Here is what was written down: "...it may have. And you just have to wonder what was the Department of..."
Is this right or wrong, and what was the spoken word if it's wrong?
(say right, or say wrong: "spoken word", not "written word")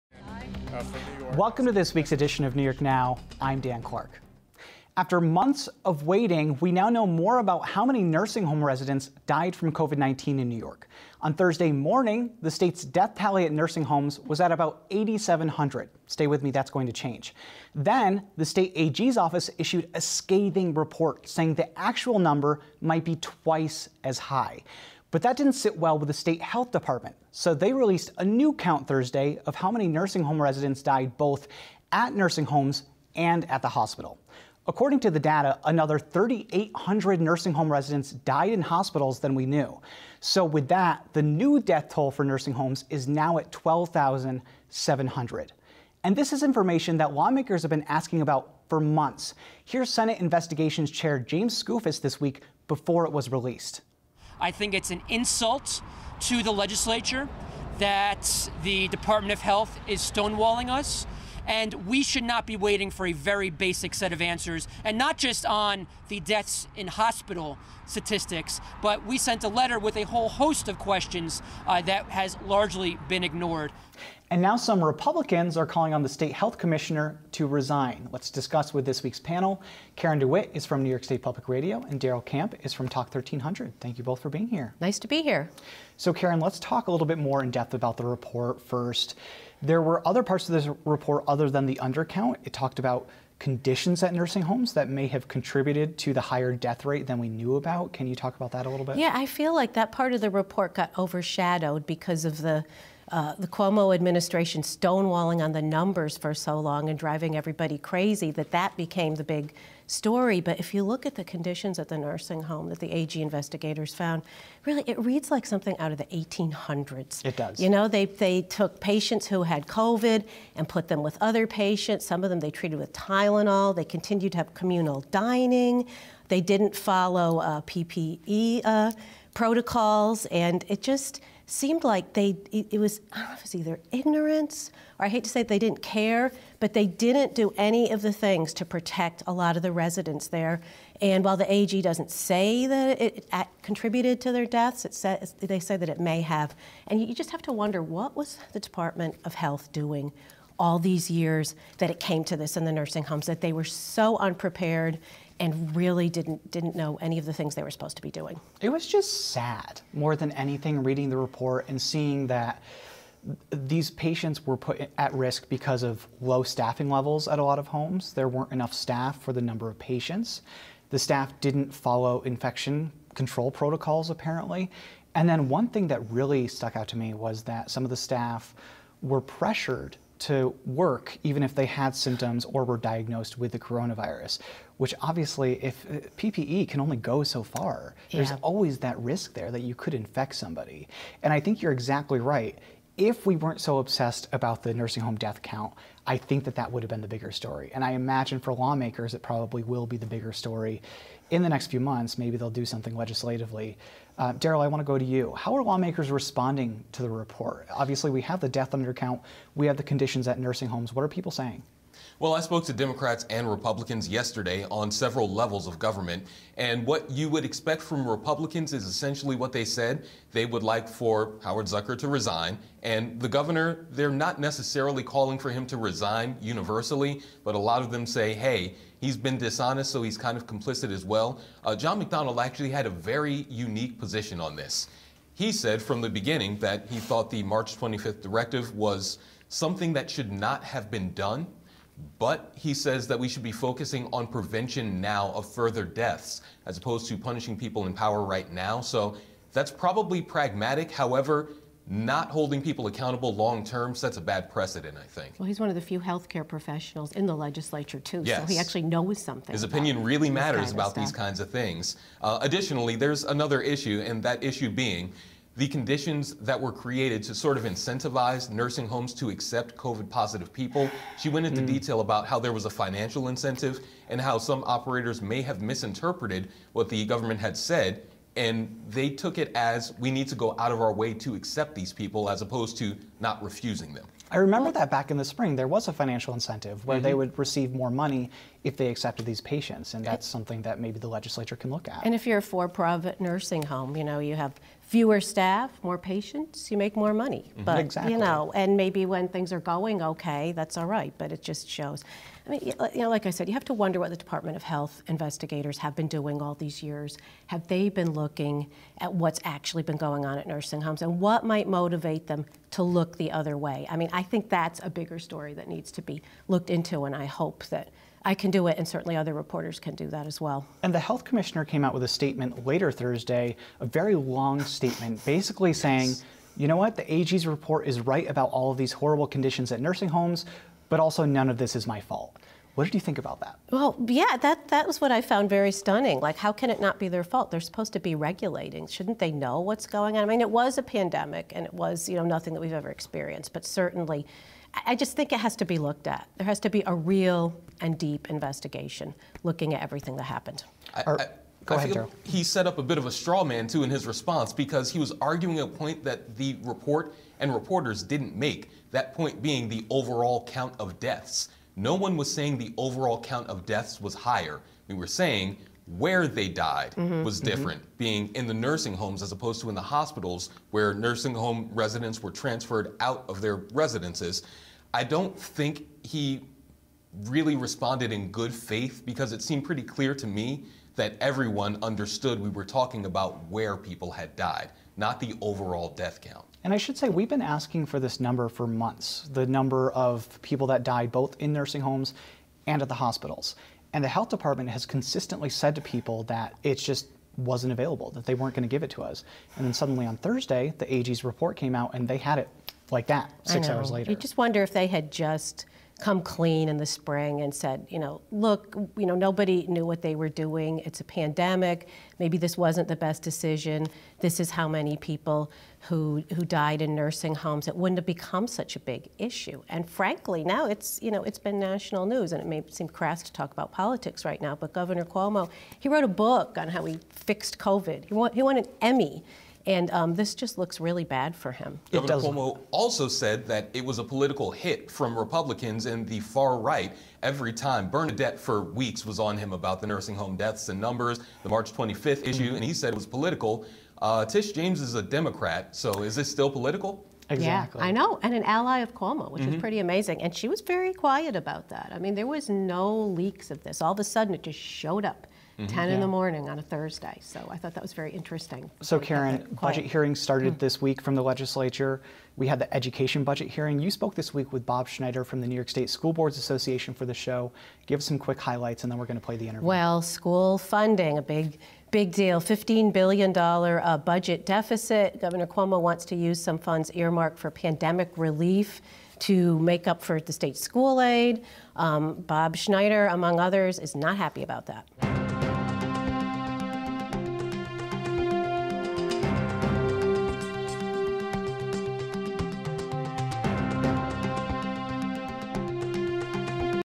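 right.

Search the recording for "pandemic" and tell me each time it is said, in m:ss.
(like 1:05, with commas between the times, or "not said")
5:40, 6:51, 7:57.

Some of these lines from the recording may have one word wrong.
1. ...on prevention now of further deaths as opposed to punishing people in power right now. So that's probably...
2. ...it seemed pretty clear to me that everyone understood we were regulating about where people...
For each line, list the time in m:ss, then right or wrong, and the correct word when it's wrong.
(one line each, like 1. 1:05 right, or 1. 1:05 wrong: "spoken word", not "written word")
1. 4:04 right
2. 6:19 wrong: "talking", not "regulating".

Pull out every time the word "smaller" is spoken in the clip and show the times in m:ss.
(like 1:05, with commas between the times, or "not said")
not said.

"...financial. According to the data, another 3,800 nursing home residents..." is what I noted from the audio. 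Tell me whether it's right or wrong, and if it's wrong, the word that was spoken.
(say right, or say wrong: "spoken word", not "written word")
wrong: "hospital", not "financial".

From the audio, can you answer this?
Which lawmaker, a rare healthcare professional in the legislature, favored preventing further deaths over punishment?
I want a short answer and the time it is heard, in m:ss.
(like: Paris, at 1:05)
John McDonald, at 3:51.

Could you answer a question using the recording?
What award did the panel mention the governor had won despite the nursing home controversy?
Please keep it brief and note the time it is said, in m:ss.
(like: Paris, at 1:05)
an Emmy, at 7:08.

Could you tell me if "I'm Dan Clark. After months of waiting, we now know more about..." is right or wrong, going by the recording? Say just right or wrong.
right.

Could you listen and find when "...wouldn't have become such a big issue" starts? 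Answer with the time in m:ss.
6:57.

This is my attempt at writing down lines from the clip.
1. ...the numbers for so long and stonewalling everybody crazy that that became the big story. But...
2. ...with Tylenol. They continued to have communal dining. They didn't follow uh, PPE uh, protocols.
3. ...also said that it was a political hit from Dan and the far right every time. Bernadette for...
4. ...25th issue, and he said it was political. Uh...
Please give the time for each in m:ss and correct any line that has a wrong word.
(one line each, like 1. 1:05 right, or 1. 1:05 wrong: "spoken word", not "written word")
1. 1:45 wrong: "driving", not "stonewalling"
2. 2:02 right
3. 7:12 wrong: "Republicans", not "Dan"
4. 7:21 right.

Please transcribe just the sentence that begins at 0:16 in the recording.
Stay with me, that's going to change.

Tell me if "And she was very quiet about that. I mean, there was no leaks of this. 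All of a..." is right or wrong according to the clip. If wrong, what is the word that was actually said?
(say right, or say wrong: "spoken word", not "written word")
right.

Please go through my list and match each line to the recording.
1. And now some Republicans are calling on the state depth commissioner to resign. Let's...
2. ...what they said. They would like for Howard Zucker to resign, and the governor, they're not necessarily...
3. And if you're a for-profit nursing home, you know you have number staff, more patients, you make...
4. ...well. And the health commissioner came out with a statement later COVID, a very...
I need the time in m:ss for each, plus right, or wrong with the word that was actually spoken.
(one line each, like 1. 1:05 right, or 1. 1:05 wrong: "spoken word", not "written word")
1. 1:14 wrong: "health", not "depth"
2. 3:39 right
3. 4:52 wrong: "fewer", not "number"
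4. 5:20 wrong: "Thursday", not "COVID".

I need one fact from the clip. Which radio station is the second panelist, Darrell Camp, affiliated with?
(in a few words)
Talk 1300.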